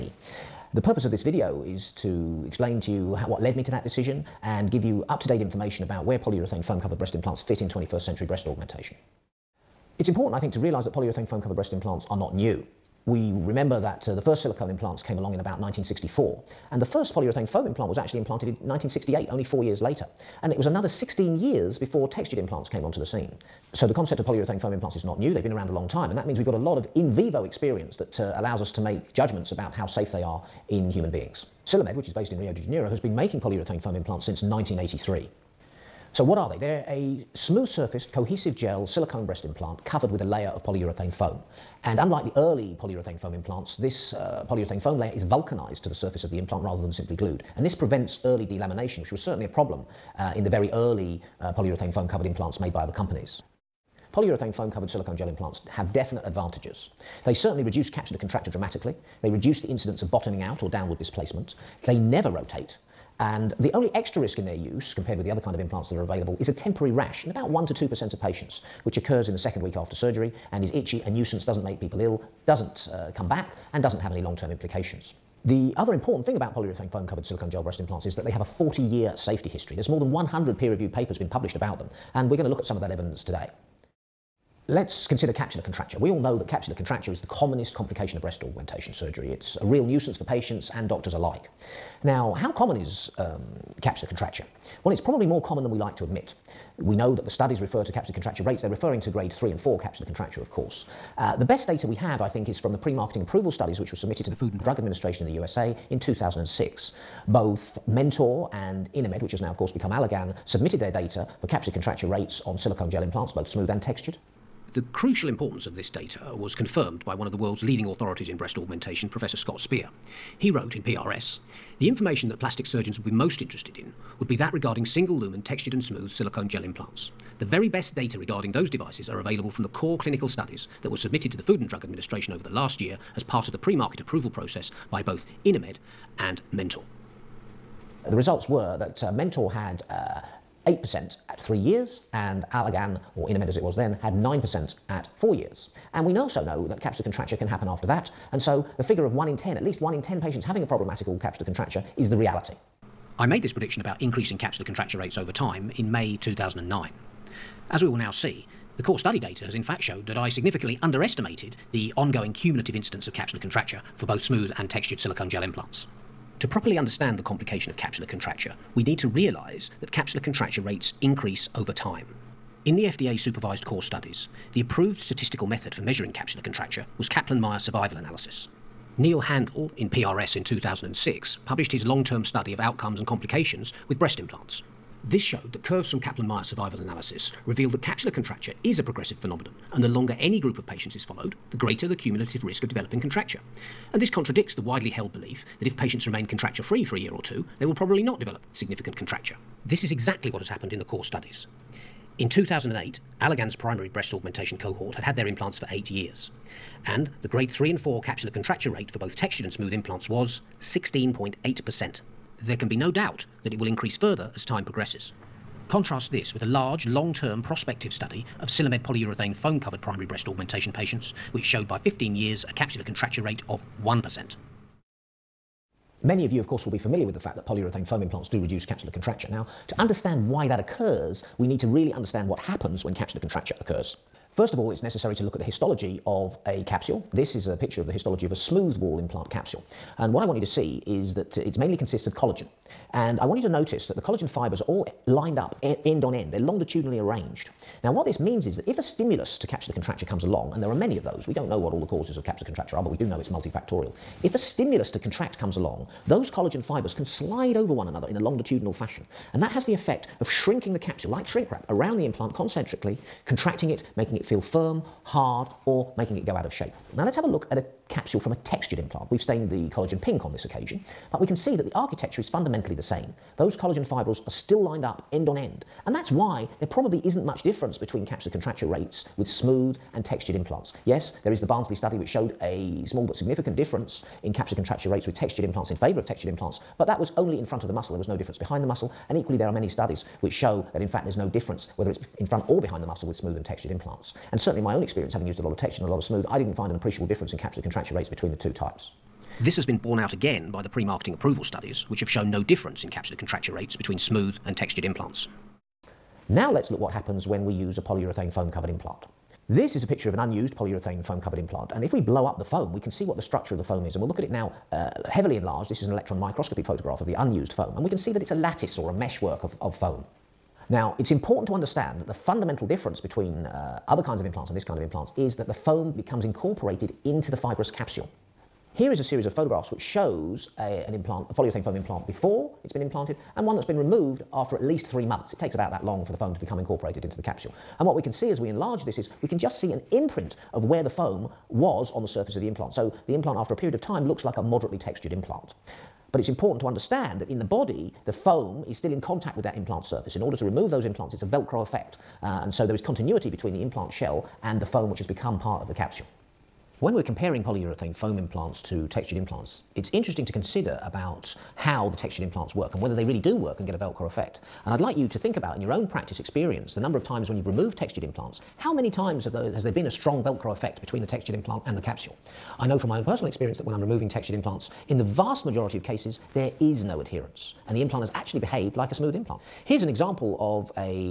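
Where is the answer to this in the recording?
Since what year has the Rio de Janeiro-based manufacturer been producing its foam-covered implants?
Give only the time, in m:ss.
0:34.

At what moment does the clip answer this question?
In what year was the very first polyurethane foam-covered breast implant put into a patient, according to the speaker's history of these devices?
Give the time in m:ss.
0:18.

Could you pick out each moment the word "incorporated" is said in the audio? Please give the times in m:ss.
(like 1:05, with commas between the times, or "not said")
5:26, 5:36.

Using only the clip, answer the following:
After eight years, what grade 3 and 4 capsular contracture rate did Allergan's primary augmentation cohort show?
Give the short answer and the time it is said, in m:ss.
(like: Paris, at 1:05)
16.8%, at 3:30.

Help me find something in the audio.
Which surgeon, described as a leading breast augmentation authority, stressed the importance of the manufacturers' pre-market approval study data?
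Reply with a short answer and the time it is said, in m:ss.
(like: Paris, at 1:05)
Scott Spear, at 1:59.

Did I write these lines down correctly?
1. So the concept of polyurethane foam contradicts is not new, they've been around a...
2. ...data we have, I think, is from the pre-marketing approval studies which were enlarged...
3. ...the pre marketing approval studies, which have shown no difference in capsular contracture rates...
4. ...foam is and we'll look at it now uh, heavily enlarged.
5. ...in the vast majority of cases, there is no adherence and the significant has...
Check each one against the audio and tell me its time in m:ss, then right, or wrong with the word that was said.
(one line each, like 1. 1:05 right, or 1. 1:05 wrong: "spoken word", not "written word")
1. 0:23 wrong: "implants", not "contradicts"
2. 1:41 wrong: "submitted", not "enlarged"
3. 5:00 right
4. 5:13 right
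5. 6:14 wrong: "implant", not "significant".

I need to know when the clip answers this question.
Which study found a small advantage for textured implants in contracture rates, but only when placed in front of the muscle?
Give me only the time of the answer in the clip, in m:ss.
4:41.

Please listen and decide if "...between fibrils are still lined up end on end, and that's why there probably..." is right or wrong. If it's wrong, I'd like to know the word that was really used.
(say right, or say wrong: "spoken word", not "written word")
wrong: "collagen", not "between".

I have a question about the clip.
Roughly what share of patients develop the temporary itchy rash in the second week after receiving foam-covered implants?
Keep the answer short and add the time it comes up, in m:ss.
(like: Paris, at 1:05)
1 to 2%, at 1:07.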